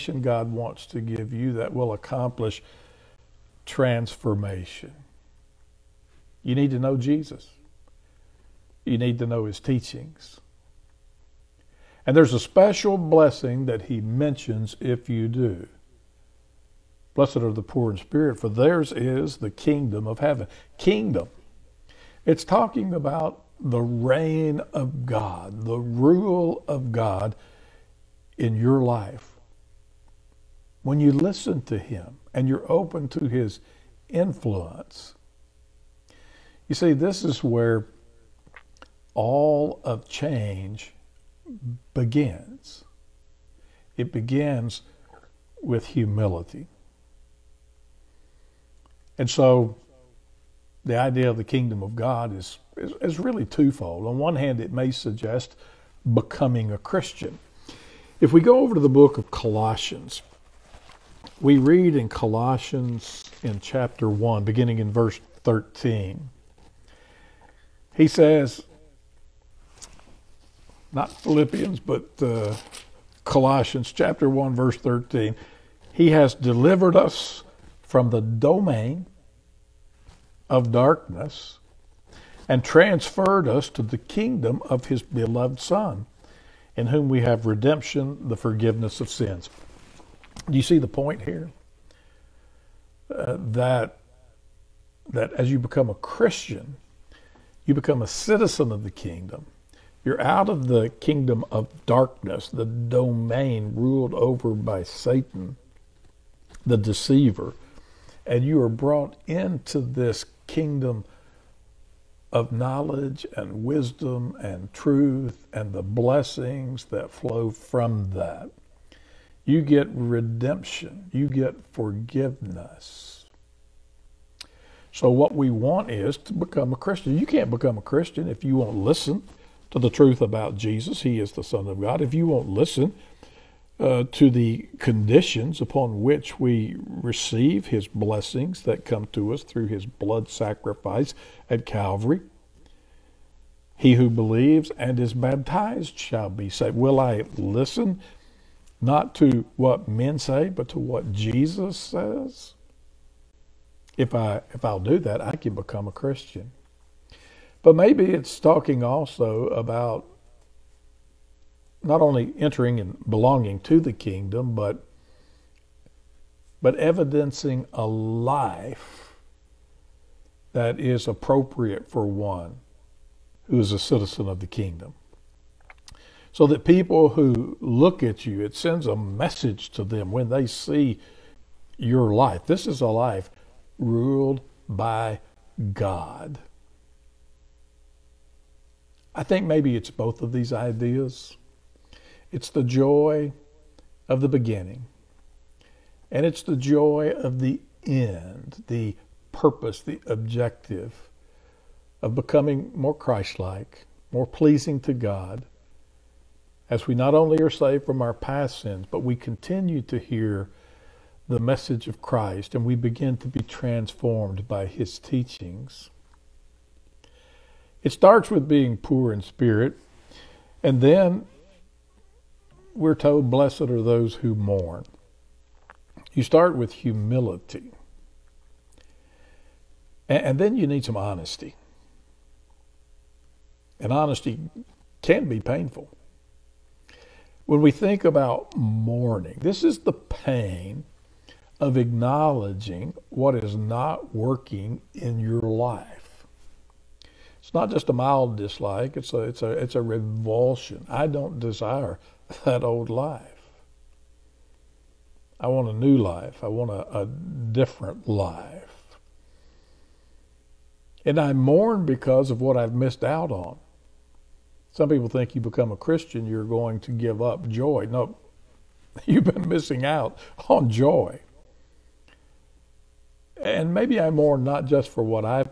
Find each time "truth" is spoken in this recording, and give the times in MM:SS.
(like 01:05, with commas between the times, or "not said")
01:54, 02:09.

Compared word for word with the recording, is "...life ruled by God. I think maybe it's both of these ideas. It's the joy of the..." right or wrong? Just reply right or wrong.
right.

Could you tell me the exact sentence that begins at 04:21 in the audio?
And I mourn because of what I've missed out on.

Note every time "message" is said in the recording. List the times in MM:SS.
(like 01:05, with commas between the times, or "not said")
02:58, 03:31.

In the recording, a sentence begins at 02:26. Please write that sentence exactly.
Will I listen not to what men say, but to what Jesus says?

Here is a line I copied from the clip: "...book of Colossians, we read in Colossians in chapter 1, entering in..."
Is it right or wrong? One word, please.
wrong.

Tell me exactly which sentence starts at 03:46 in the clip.
You start with humility, and then you need some honesty.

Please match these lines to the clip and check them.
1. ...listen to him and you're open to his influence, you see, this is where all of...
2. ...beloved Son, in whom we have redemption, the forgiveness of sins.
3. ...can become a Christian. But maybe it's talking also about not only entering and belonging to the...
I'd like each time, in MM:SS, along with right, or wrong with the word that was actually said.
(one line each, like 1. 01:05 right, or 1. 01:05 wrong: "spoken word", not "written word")
1. 00:31 right
2. 01:25 right
3. 02:35 right.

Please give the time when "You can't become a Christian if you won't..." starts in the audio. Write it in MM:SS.
02:07.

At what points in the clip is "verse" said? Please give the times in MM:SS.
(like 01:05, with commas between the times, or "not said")
01:04, 01:14.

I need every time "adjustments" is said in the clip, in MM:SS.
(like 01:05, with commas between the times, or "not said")
not said.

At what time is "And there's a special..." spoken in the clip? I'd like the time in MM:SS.
00:12.